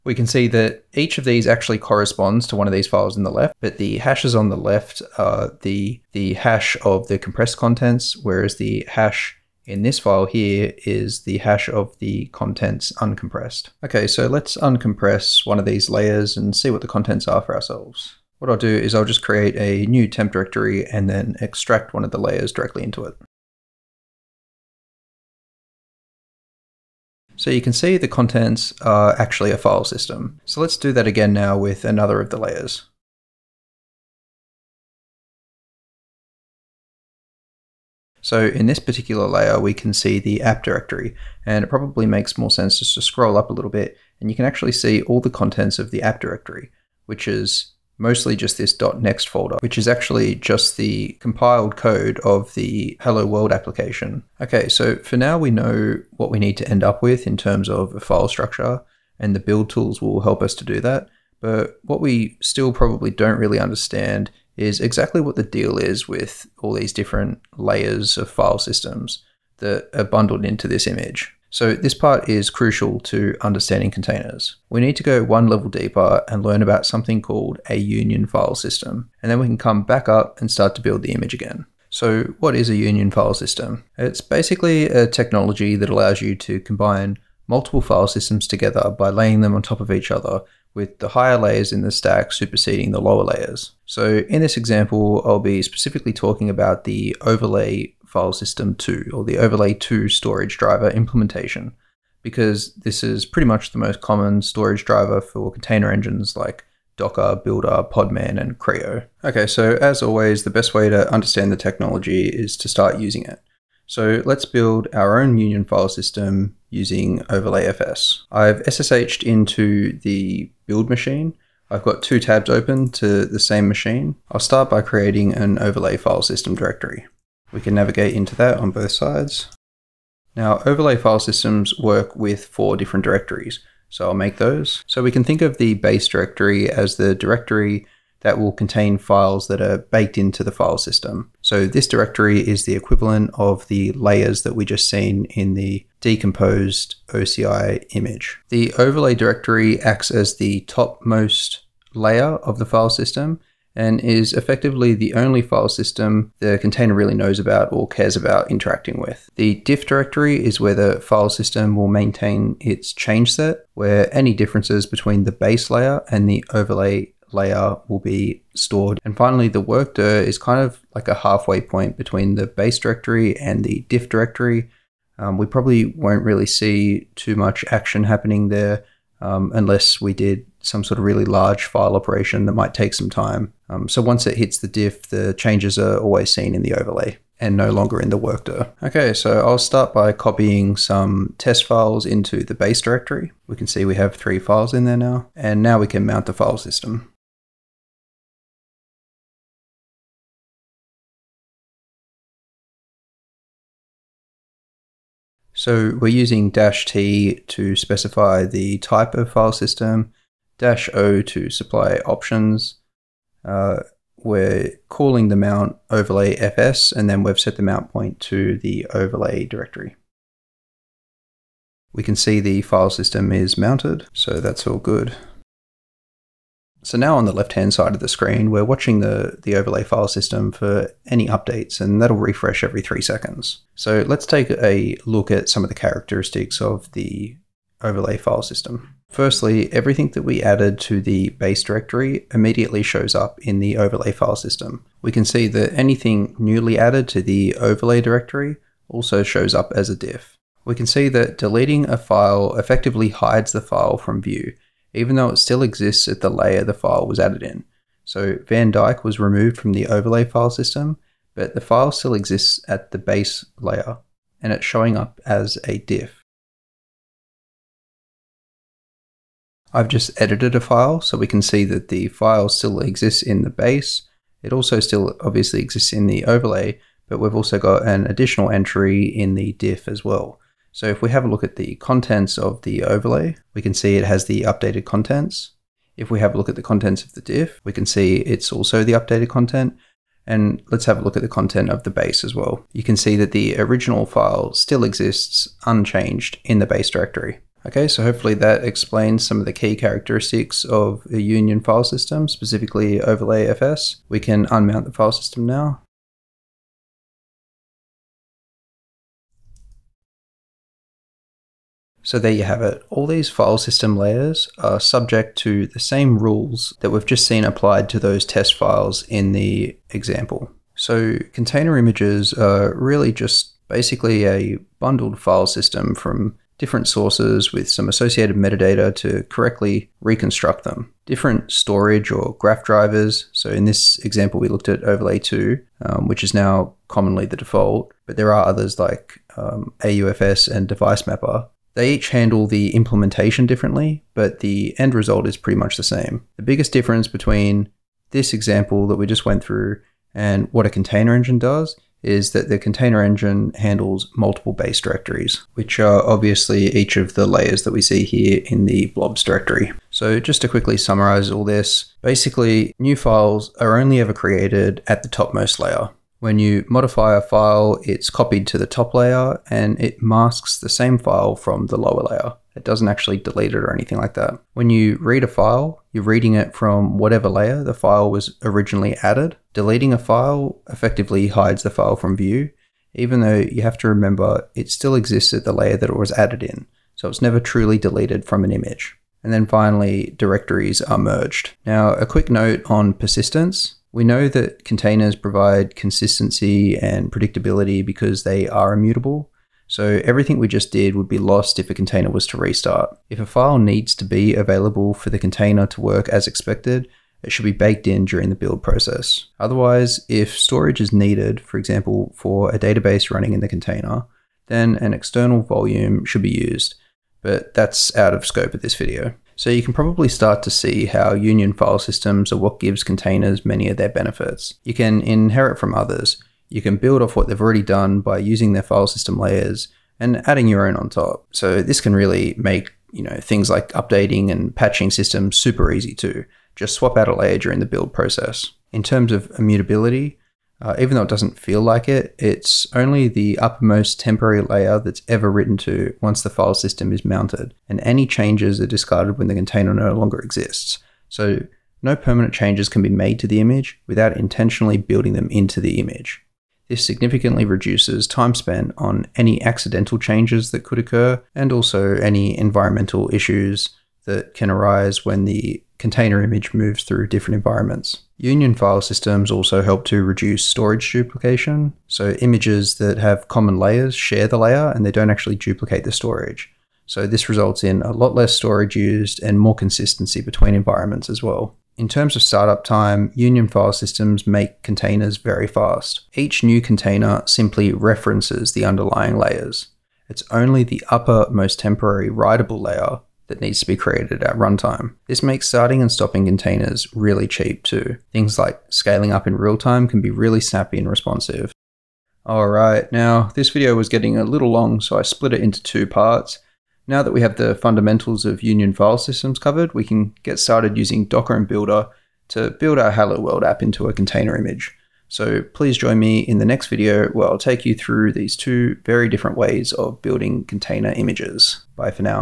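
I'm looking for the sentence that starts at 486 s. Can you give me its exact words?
Each new container simply references the underlying layers.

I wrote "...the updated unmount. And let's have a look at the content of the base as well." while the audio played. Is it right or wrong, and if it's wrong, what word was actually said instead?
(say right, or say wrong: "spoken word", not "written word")
wrong: "content", not "unmount".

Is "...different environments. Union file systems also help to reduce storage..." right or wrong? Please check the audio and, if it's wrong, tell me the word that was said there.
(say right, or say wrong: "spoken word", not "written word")
right.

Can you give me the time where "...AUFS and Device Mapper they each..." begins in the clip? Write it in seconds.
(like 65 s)
339 s.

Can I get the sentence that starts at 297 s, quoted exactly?
Okay, so hopefully that explains some of the key characteristics of a union file system, specifically overlay FS.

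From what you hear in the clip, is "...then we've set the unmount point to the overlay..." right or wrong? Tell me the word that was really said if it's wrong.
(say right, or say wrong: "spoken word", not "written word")
wrong: "mount", not "unmount".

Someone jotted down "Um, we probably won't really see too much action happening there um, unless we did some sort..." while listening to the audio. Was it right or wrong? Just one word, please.
right.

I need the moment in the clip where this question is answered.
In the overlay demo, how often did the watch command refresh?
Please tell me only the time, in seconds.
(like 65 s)
232 s.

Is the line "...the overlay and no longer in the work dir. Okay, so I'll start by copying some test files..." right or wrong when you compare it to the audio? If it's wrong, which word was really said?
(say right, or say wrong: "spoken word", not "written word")
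right.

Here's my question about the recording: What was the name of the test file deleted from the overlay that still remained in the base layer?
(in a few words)
Van Dyke.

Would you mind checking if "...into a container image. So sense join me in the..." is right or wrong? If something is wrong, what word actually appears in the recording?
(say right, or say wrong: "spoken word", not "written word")
wrong: "please", not "sense".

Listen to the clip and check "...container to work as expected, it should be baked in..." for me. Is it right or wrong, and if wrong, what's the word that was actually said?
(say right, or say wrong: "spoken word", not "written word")
right.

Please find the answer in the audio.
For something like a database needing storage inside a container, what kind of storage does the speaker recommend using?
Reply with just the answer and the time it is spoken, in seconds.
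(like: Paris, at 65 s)
external volume, at 414 s.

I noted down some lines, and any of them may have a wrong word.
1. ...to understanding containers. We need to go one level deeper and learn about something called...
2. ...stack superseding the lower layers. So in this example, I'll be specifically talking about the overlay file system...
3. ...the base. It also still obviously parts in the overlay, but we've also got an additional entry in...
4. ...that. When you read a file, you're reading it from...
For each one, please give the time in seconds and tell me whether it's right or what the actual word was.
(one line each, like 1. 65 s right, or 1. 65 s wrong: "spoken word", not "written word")
1. 73 s right
2. 91 s right
3. 273 s wrong: "exists", not "parts"
4. 374 s right.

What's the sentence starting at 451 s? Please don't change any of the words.
So no permanent changes can be made to the image without intentionally building them into the image.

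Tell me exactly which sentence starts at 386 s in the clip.
So it's never truly deleted from an image.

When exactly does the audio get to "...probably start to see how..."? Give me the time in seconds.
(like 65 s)
419 s.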